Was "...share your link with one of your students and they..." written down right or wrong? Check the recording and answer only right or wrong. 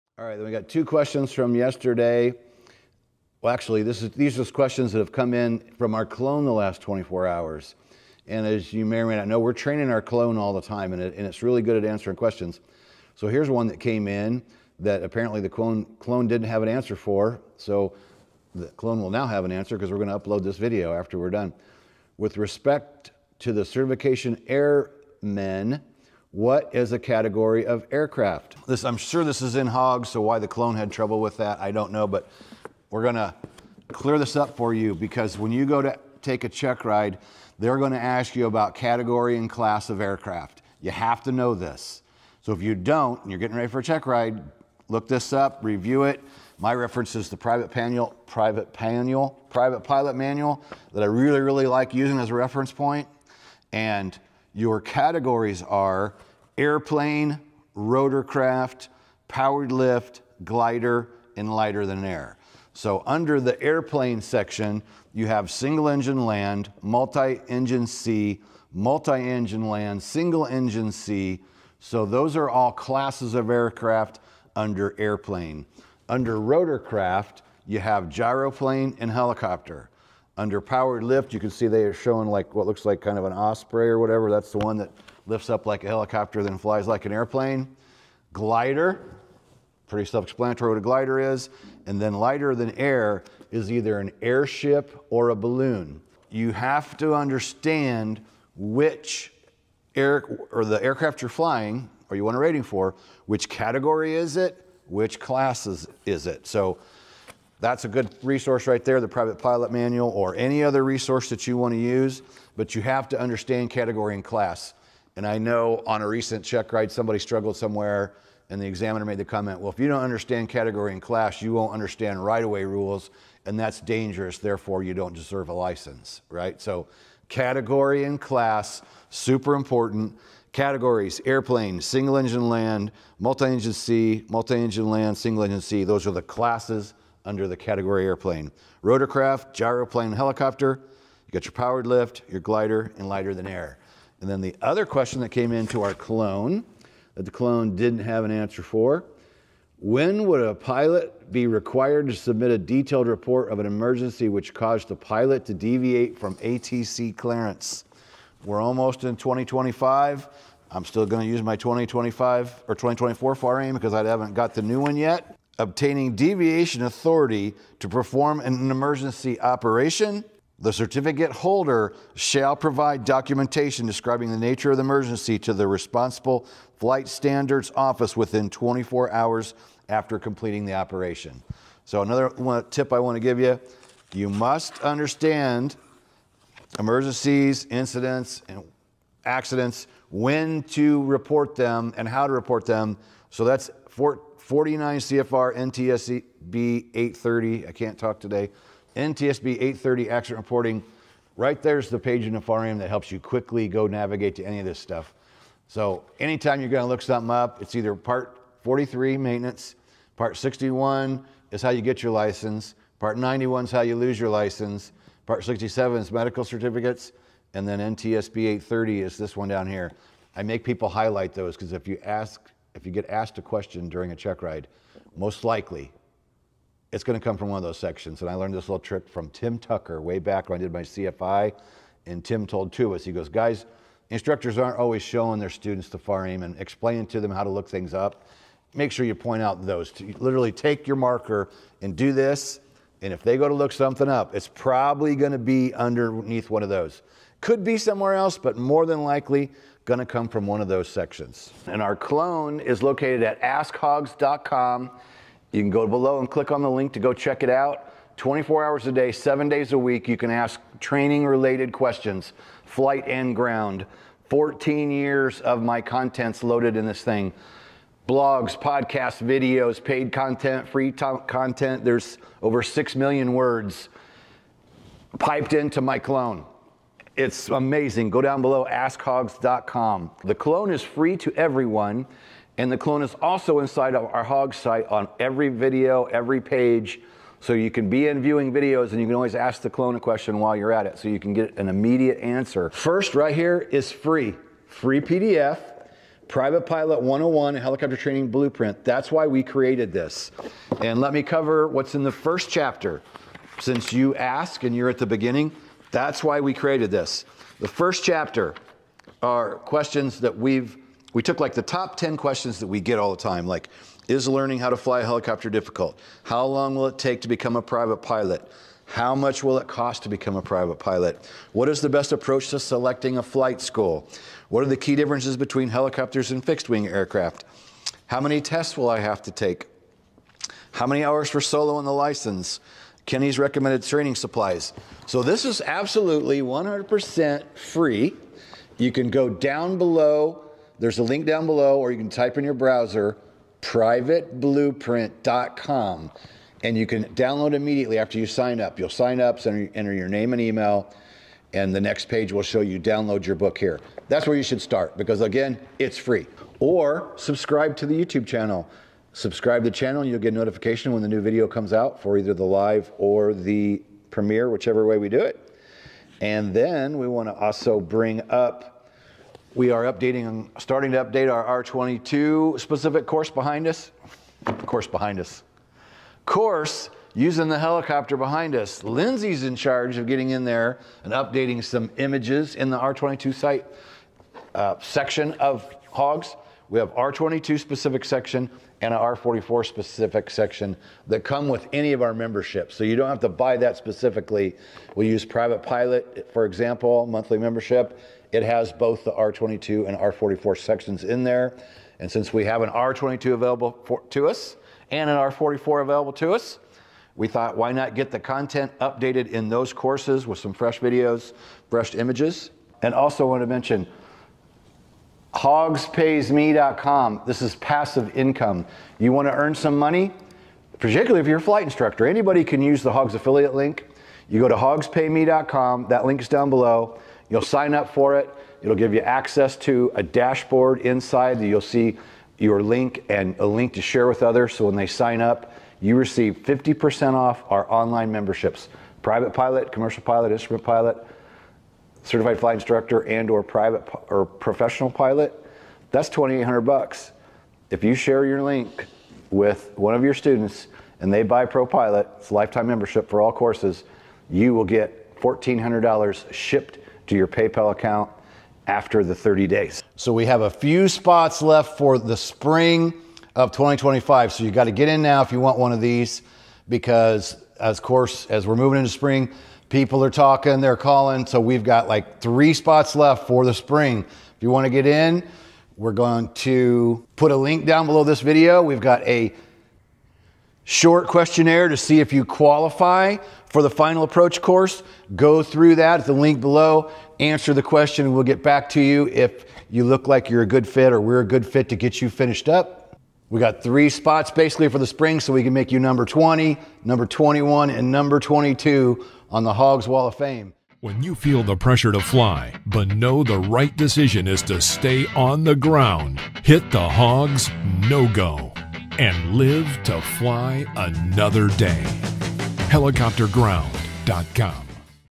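right.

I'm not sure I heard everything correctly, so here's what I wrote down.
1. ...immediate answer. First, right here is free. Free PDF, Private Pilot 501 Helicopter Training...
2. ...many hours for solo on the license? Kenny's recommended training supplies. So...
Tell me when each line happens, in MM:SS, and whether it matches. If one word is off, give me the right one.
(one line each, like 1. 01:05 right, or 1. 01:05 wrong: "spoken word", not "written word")
1. 04:51 wrong: "101", not "501"
2. 05:30 right.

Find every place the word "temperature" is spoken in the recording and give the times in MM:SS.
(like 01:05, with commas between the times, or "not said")
not said.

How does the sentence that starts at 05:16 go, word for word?
How long will it take to become a private pilot?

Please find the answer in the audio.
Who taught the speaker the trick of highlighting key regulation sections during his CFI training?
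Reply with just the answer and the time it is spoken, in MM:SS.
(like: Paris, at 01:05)
Tim Tucker, at 03:49.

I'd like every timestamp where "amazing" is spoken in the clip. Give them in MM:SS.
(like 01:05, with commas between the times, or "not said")
04:37.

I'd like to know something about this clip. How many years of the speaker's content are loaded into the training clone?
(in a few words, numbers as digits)
14 years.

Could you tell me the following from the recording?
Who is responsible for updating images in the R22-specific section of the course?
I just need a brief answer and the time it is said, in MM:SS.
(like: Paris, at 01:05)
Lindsay, at 06:18.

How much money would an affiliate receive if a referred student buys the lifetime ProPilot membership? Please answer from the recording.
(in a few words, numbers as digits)
$1400.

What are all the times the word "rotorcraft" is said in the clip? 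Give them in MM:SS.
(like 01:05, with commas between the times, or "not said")
00:57, 01:16, 02:18.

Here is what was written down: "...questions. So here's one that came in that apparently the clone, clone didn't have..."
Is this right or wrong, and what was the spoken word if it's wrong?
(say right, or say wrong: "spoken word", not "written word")
right.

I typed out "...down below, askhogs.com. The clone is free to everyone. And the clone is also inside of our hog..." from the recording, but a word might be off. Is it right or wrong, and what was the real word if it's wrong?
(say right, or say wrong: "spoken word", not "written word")
right.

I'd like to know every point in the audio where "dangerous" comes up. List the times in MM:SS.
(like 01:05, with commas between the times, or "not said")
02:03.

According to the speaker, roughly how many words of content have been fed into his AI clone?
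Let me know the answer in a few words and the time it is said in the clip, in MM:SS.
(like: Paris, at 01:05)
Over 6 million, at 04:32.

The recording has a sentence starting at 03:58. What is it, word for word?
Make sure you point out those.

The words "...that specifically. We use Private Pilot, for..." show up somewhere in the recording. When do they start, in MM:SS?
06:33.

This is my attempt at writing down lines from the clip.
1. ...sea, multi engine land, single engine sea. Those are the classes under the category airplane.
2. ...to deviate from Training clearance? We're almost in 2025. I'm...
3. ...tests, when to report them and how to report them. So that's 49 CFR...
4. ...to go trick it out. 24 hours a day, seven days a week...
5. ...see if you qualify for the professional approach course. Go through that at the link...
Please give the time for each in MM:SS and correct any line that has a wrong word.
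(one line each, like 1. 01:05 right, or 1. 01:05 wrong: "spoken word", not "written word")
1. 02:13 right
2. 02:35 wrong: "ATC", not "Training"
3. 03:09 wrong: "accidents", not "tests"
4. 04:16 wrong: "check", not "trick"
5. 08:01 wrong: "final", not "professional".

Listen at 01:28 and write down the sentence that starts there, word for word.
Glider, pretty self explanatory what a glider is.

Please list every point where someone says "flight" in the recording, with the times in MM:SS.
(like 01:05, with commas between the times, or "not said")
02:56, 04:22, 05:23, 07:01, 07:22.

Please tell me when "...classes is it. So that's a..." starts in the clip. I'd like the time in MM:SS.
01:45.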